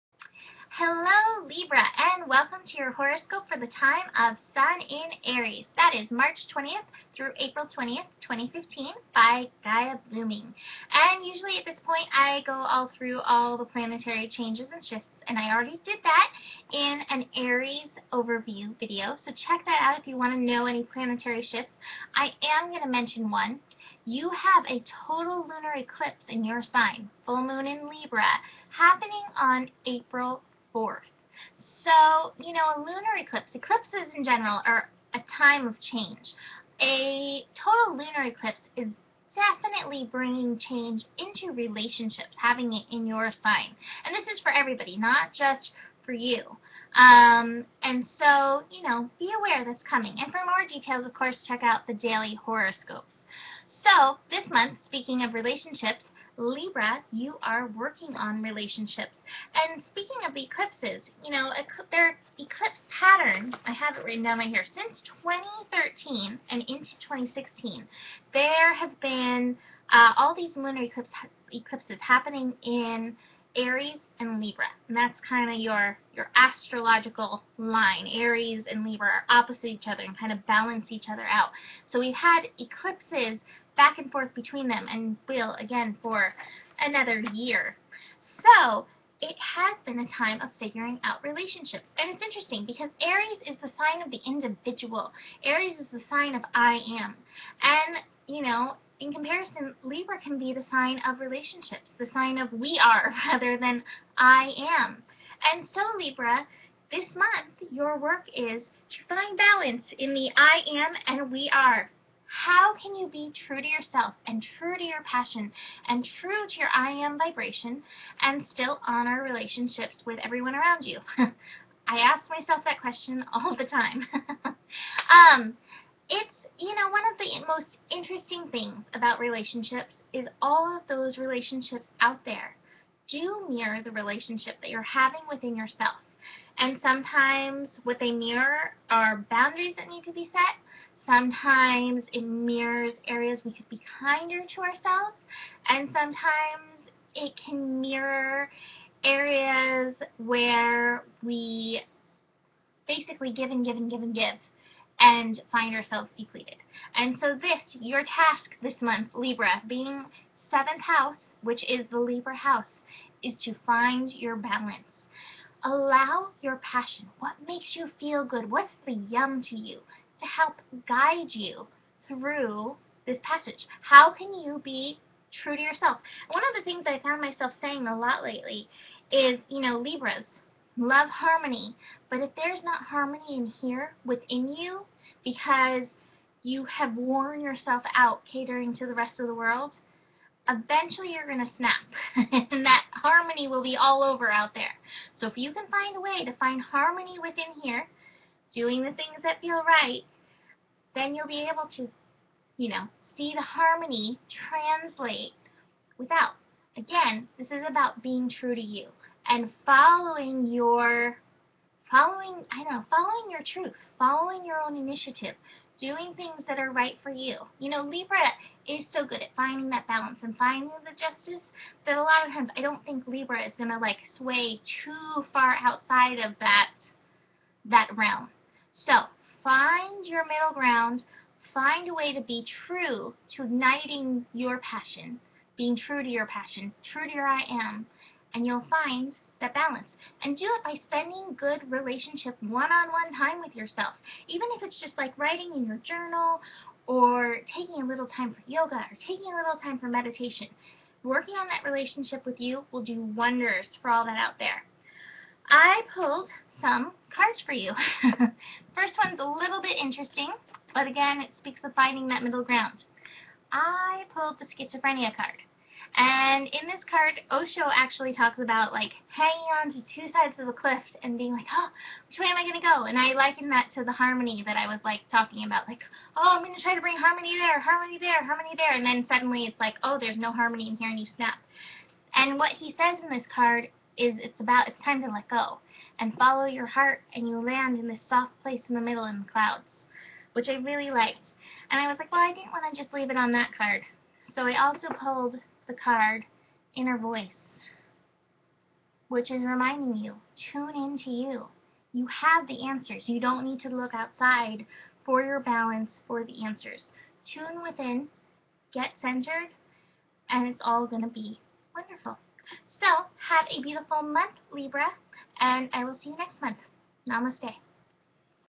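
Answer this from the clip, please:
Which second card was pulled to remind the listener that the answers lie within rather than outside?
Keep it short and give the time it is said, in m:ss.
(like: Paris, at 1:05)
Inner voice, at 4:56.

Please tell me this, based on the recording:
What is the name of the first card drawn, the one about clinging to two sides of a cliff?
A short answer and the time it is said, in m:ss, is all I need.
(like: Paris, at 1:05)
Schizophrenia, at 4:24.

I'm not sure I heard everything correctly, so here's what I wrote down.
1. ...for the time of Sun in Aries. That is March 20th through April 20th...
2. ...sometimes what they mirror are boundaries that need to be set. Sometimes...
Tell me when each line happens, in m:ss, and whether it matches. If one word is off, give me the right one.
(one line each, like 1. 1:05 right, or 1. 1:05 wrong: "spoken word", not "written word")
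1. 0:03 right
2. 2:16 right.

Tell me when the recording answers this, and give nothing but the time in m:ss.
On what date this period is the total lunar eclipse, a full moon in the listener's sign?
0:29.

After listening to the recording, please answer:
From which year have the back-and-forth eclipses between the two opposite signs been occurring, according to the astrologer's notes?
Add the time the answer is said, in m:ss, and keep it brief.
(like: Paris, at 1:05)
2013, at 1:05.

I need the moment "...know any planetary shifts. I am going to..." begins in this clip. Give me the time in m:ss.
0:20.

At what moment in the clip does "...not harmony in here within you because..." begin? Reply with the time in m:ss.
3:02.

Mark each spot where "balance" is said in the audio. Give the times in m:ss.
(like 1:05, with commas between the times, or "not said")
1:20, 1:49, 2:44, 3:39, 3:59, 5:05.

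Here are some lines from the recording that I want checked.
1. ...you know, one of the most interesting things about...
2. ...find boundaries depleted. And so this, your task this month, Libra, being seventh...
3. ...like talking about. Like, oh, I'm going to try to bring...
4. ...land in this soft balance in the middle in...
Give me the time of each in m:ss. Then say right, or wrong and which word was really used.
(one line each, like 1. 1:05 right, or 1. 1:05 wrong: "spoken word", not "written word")
1. 2:06 right
2. 2:35 wrong: "ourselves", not "boundaries"
3. 4:34 right
4. 4:47 wrong: "place", not "balance".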